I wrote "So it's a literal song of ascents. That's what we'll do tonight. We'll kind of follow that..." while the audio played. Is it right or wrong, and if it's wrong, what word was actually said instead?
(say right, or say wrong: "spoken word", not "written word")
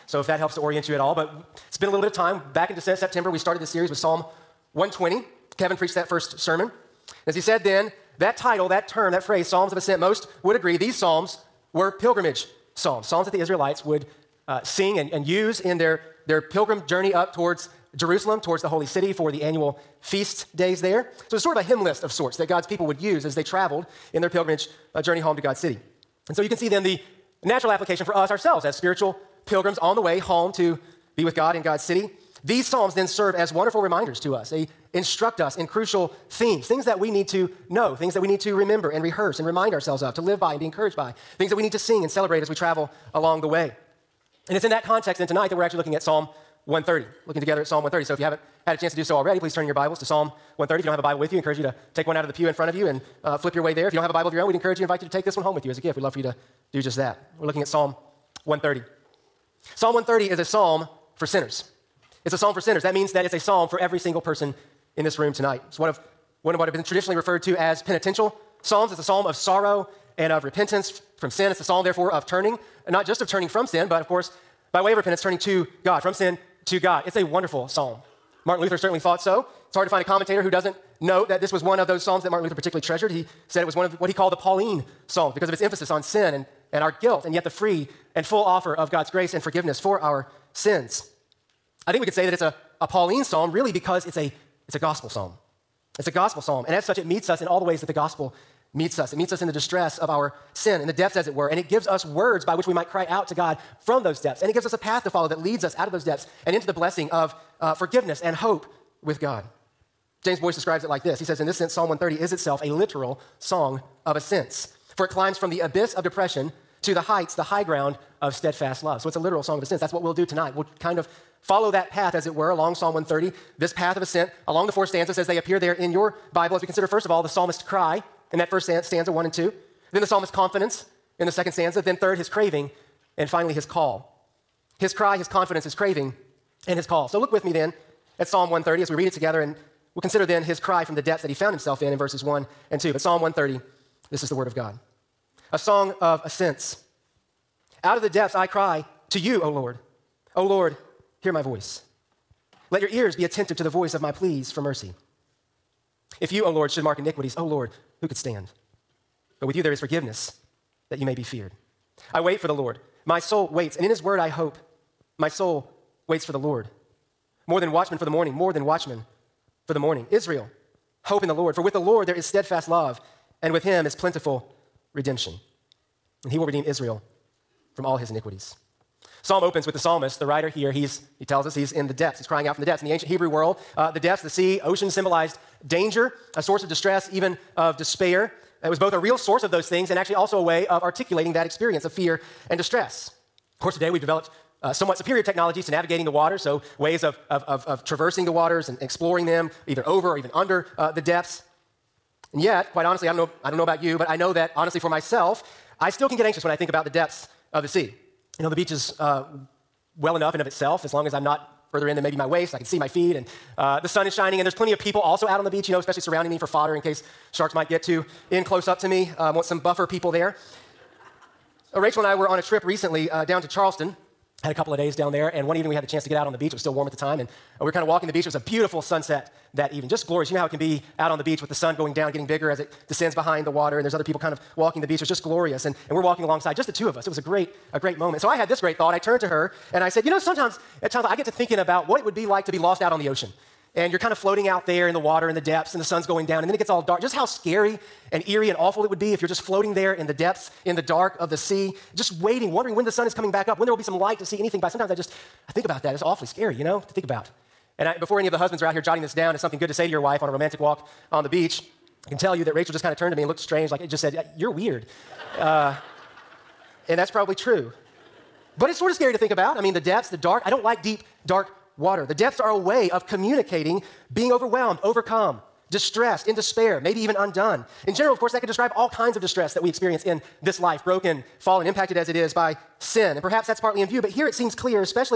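right.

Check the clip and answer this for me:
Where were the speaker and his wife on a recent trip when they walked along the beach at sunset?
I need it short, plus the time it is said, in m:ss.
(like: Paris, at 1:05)
Charleston, at 3:43.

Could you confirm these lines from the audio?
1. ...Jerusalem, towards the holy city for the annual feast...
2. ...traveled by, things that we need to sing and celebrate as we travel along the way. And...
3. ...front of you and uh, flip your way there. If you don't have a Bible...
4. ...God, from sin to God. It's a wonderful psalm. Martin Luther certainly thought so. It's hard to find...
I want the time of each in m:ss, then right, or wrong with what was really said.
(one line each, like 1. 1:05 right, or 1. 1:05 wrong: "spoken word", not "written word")
1. 0:17 right
2. 0:40 wrong: "encouraged", not "traveled"
3. 0:52 right
4. 1:15 right.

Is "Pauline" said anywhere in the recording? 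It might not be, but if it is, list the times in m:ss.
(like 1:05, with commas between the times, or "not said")
1:24, 1:32.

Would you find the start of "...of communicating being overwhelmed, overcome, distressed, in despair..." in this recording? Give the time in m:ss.
4:32.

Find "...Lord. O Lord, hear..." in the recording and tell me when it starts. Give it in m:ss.
2:29.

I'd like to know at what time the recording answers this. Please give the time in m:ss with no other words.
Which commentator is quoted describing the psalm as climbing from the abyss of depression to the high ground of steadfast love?
1:50.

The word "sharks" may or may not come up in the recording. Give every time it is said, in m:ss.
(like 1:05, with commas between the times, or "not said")
3:37.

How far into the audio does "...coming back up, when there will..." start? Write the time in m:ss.
4:13.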